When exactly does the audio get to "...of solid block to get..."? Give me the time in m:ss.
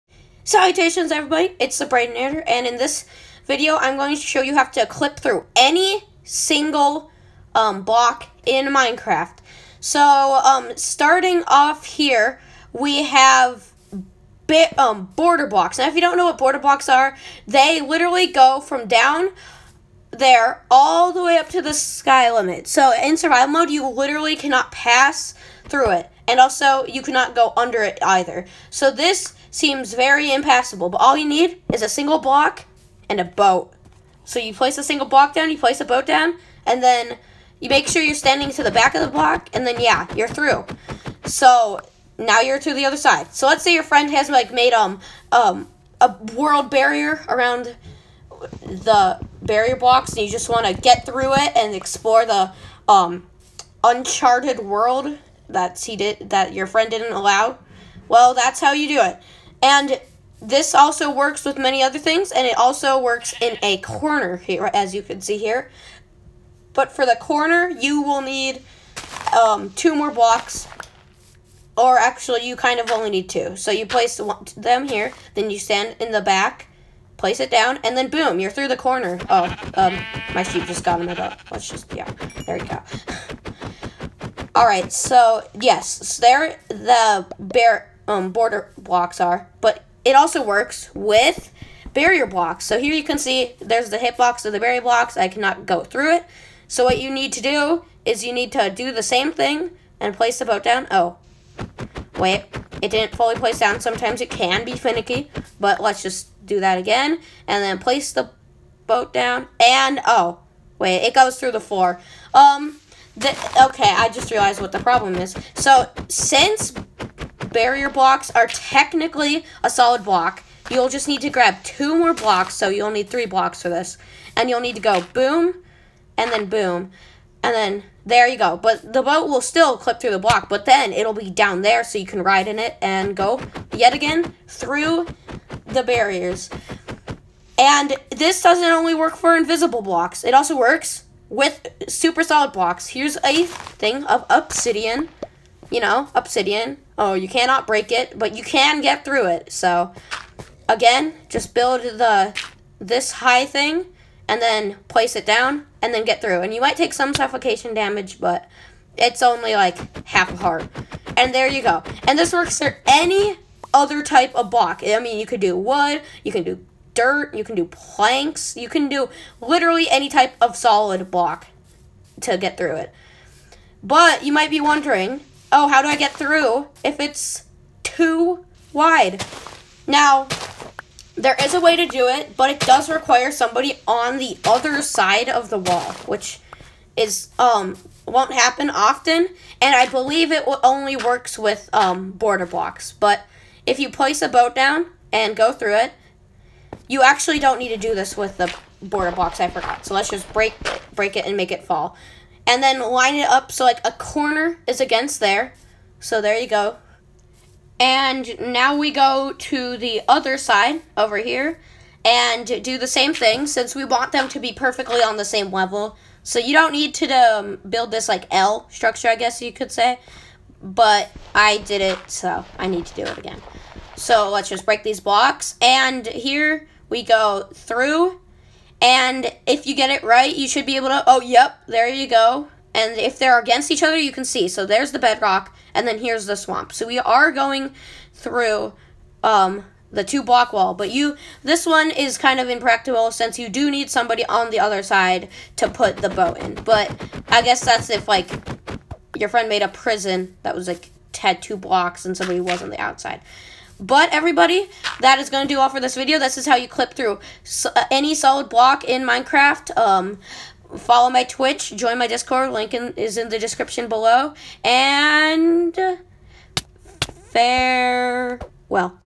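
2:50.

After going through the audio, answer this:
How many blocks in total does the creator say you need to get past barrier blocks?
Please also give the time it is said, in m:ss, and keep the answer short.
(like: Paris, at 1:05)
3, at 2:03.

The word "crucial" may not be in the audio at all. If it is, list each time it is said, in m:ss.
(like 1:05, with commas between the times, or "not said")
not said.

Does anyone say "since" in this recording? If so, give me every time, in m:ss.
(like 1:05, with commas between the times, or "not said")
1:56, 3:33, 4:03.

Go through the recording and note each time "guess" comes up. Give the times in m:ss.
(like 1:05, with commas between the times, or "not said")
3:39, 4:07.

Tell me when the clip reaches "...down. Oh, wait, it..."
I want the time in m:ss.
1:40.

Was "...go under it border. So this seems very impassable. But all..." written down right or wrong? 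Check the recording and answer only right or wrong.
wrong.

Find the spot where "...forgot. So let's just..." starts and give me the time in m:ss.
3:19.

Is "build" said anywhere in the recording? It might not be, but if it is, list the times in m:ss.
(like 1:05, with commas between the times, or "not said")
2:31, 3:37.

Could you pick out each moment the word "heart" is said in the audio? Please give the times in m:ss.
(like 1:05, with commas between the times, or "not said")
2:40.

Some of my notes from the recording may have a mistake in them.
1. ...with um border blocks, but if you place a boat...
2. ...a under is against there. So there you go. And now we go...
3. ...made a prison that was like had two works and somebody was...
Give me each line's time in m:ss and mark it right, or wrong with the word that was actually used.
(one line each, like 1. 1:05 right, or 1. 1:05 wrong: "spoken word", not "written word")
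1. 3:11 right
2. 3:23 wrong: "corner", not "under"
3. 4:09 wrong: "blocks", not "works".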